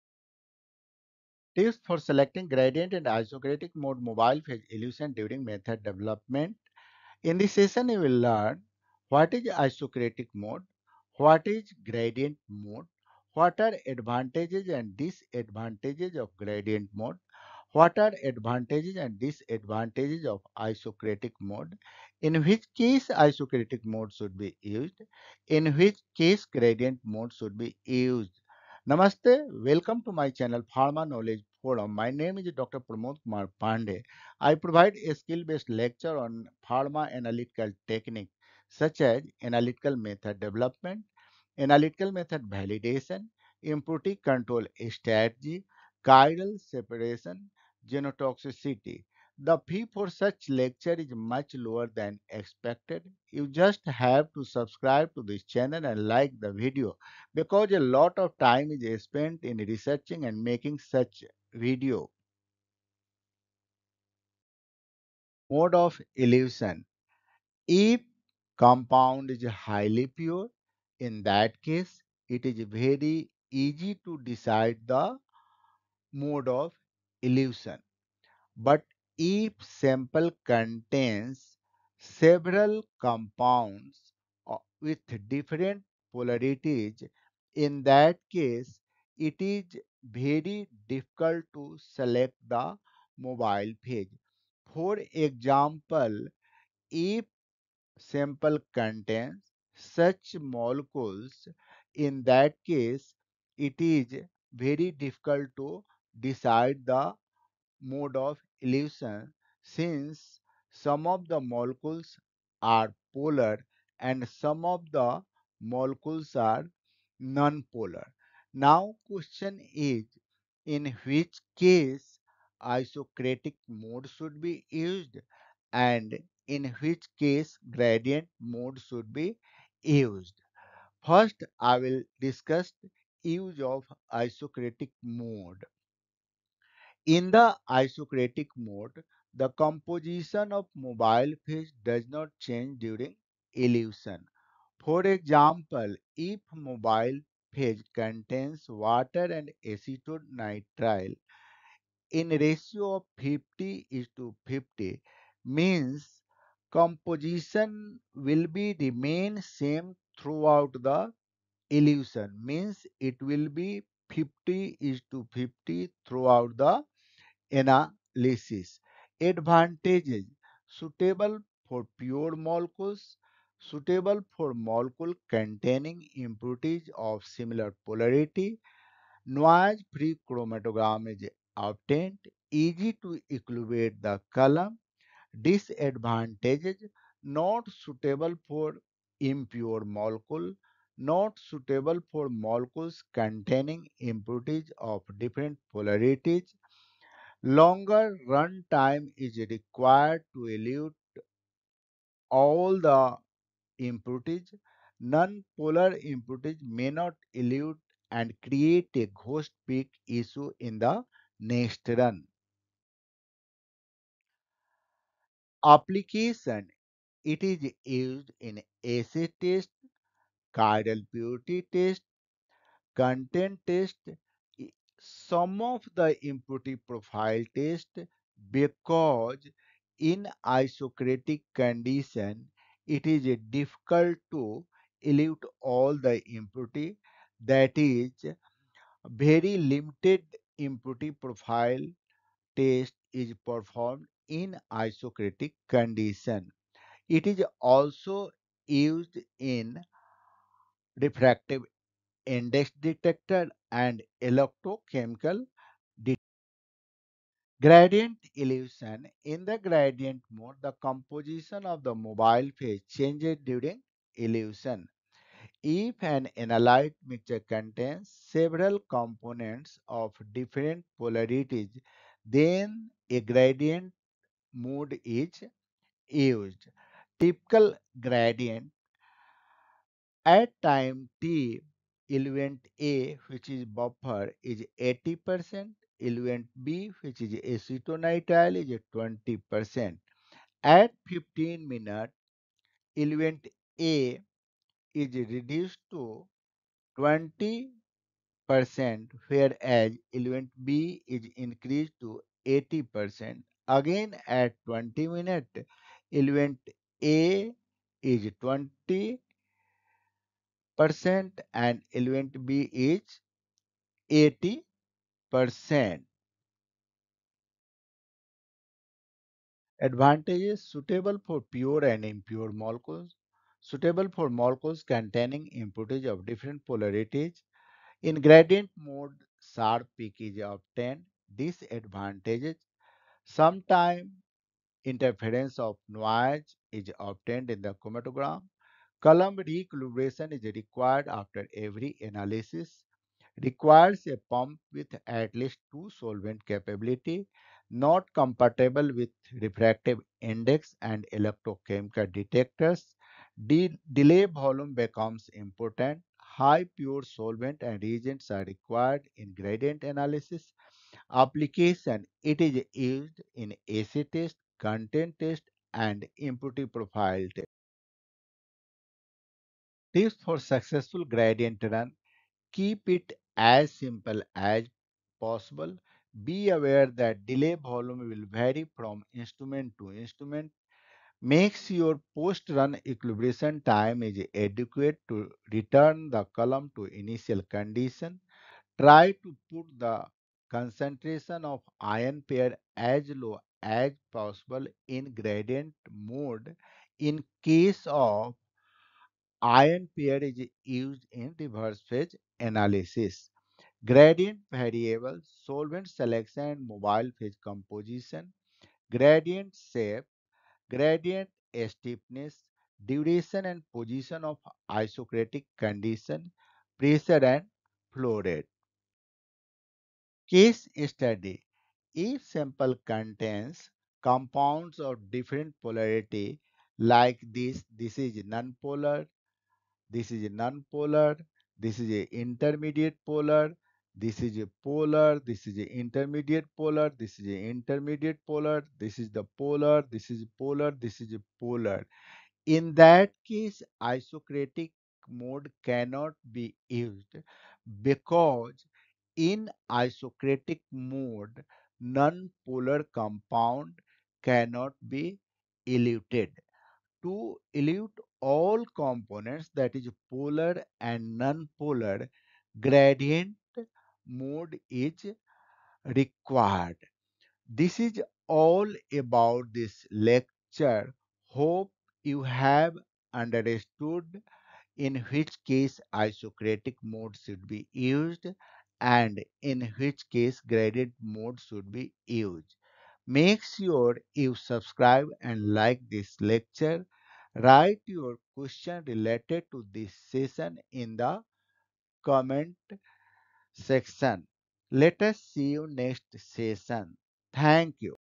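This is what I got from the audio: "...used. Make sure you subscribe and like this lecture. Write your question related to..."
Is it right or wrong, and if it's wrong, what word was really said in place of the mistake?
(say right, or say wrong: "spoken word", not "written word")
right.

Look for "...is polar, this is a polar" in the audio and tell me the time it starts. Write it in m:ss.
7:20.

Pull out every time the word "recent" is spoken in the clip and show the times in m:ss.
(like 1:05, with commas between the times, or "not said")
not said.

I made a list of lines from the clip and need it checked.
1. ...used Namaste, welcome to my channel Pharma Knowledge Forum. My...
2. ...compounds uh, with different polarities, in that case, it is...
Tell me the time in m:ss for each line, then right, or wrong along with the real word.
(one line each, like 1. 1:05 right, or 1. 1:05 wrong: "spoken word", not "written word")
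1. 0:27 right
2. 1:22 right.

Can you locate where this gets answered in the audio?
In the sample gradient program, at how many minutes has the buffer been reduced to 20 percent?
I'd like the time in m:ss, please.
4:51.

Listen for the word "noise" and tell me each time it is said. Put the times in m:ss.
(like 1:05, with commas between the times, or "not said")
2:59, 5:35.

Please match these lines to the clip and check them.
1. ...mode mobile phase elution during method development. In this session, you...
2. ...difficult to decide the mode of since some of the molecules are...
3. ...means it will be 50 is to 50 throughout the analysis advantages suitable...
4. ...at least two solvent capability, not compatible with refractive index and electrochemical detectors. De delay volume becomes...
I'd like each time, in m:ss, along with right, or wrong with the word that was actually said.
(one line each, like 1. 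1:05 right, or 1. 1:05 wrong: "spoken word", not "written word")
1. 0:03 right
2. 1:44 right
3. 2:42 right
4. 5:45 right.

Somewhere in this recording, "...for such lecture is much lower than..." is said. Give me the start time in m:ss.
0:49.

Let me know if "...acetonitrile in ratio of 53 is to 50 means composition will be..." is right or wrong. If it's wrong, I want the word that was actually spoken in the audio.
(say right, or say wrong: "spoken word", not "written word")
wrong: "50", not "53".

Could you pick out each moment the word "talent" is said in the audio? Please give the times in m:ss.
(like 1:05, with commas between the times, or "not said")
not said.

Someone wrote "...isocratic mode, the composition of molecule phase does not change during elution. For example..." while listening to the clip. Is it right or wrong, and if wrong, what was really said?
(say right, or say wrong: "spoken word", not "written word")
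wrong: "mobile", not "molecule".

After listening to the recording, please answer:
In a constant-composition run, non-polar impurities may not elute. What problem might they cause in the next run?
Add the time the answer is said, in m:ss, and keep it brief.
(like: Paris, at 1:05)
Ghost peak, at 3:29.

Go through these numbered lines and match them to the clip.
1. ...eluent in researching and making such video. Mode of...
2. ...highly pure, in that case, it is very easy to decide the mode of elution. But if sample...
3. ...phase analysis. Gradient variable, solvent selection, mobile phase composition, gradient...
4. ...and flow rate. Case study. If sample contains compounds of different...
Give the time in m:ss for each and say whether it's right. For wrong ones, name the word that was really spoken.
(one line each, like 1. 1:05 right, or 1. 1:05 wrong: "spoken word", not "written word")
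1. 0:59 wrong: "spent", not "eluent"
2. 1:09 right
3. 6:41 right
4. 6:57 right.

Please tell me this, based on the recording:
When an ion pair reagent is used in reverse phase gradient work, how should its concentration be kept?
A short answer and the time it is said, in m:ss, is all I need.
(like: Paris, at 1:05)
As low as possible, at 6:32.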